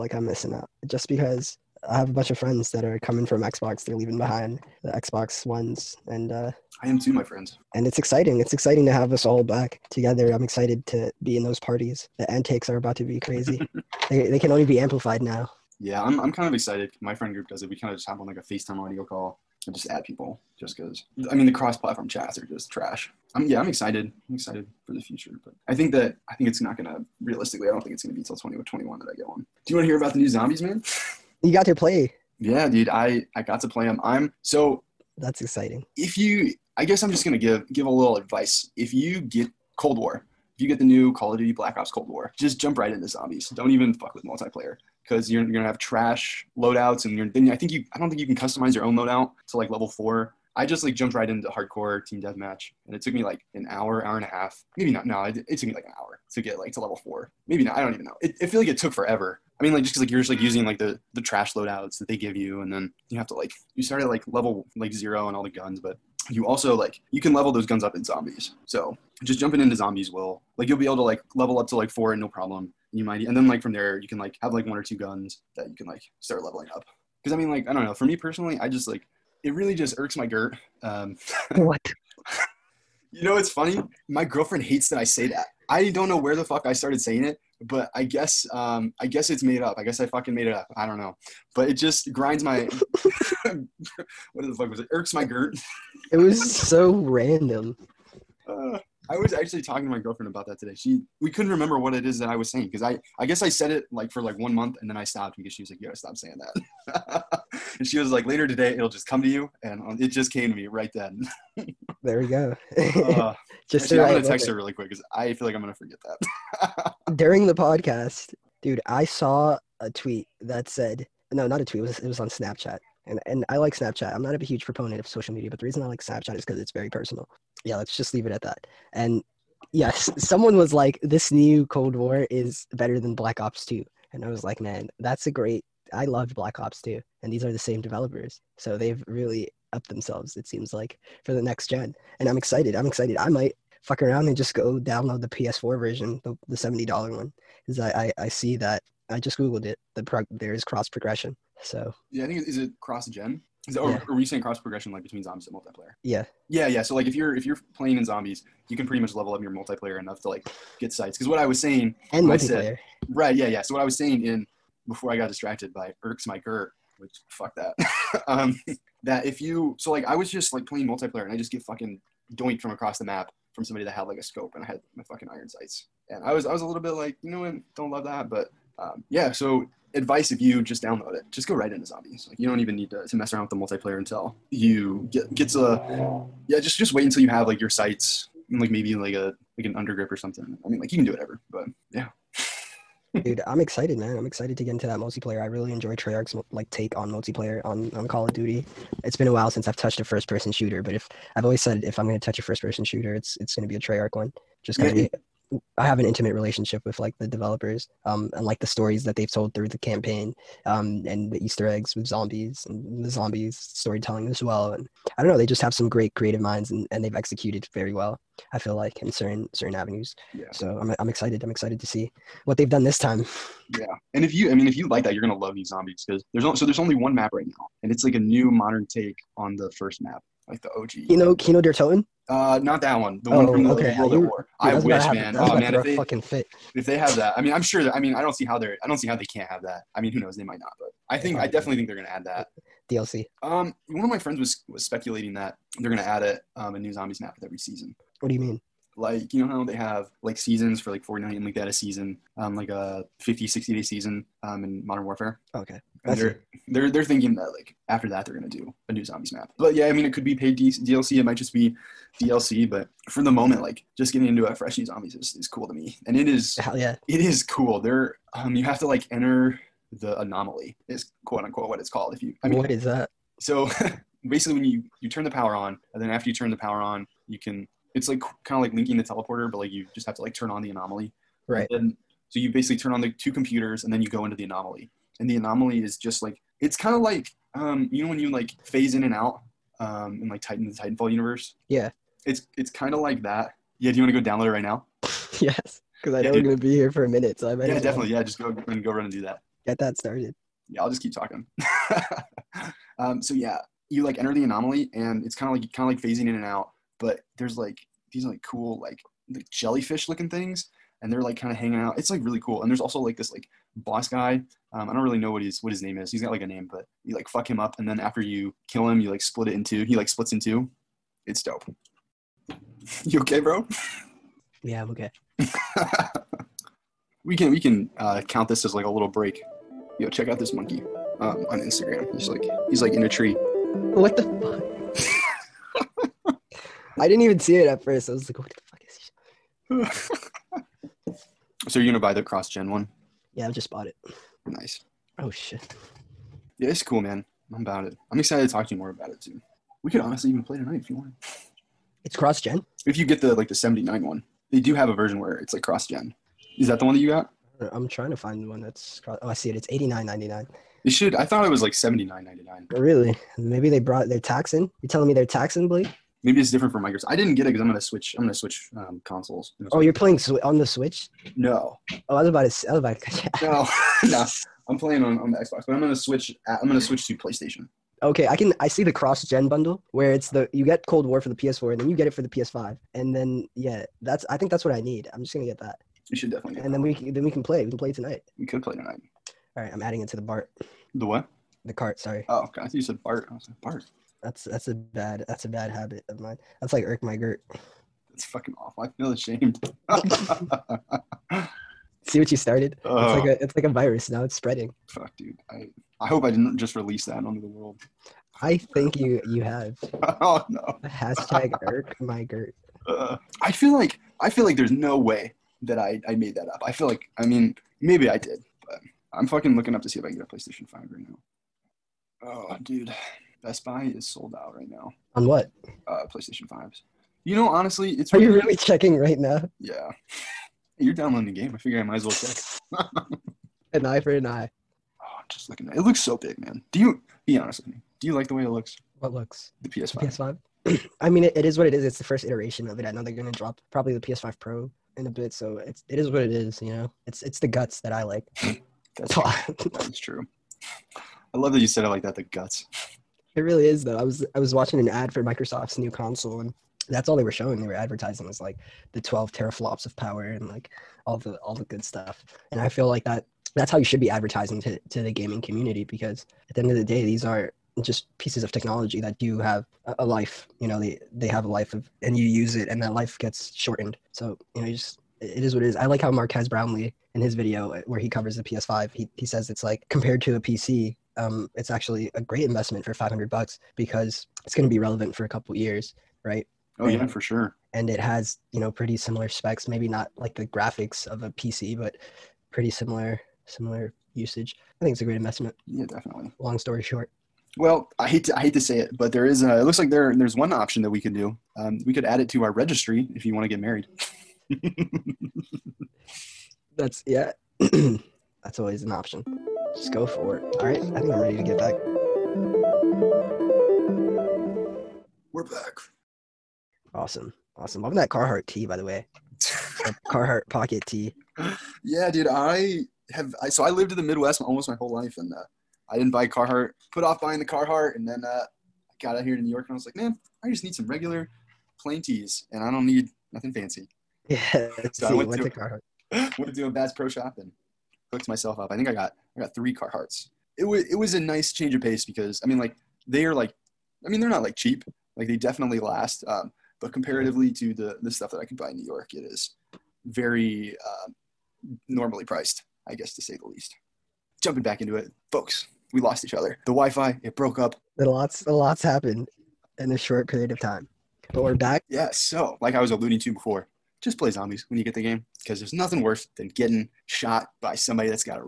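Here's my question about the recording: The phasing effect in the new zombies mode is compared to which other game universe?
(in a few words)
Titanfall.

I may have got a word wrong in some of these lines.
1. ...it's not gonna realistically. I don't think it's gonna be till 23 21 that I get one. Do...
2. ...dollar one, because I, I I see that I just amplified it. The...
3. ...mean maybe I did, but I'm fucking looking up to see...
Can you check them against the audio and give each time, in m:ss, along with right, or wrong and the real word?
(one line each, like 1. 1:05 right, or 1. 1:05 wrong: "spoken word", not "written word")
1. 0:26 wrong: "20", not "23"
2. 2:26 wrong: "googled", not "amplified"
3. 6:57 right.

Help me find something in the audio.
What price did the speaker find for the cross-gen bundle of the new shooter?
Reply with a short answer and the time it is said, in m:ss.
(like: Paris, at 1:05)
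$89.99, at 5:59.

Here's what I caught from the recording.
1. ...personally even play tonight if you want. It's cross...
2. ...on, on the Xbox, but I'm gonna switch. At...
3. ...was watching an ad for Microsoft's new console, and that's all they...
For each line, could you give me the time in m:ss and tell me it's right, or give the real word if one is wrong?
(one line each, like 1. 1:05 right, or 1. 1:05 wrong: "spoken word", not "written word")
1. 5:49 wrong: "honestly", not "personally"
2. 6:15 right
3. 7:34 right.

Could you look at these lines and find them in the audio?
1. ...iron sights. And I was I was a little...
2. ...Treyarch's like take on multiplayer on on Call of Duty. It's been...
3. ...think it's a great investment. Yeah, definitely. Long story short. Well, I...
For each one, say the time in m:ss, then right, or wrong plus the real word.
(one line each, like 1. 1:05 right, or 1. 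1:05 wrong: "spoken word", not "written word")
1. 2:55 right
2. 3:15 right
3. 8:14 right.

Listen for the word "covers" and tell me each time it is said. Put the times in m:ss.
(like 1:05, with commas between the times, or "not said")
7:58.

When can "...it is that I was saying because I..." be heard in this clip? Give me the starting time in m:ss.
1:41.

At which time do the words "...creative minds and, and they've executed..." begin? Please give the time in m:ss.
3:36.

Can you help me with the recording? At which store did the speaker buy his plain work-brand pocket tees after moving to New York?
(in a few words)
Bass Pro Shop.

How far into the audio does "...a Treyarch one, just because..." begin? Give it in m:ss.
3:23.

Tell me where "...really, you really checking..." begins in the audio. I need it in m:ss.
7:08.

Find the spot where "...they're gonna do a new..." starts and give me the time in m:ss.
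4:18.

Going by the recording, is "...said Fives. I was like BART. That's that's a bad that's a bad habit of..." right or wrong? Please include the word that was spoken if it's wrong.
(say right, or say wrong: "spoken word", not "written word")
wrong: "BART", not "Fives".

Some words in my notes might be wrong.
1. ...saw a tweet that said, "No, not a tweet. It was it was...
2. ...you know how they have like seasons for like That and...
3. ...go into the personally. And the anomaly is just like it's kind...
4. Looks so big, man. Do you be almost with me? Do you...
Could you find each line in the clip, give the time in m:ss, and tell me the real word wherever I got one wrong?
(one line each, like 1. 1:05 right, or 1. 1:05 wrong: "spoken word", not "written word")
1. 1:59 right
2. 4:09 wrong: "Fortnite", not "That"
3. 4:44 wrong: "anomaly", not "personally"
4. 7:15 wrong: "honest", not "almost".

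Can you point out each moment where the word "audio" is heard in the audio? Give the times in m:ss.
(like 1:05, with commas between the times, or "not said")
0:18.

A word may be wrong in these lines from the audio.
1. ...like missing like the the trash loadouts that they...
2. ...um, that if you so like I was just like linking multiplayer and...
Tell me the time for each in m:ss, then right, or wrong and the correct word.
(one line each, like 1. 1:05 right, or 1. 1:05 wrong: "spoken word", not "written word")
1. 1:00 wrong: "using", not "missing"
2. 2:48 wrong: "playing", not "linking".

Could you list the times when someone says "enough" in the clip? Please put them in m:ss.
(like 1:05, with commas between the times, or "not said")
2:39.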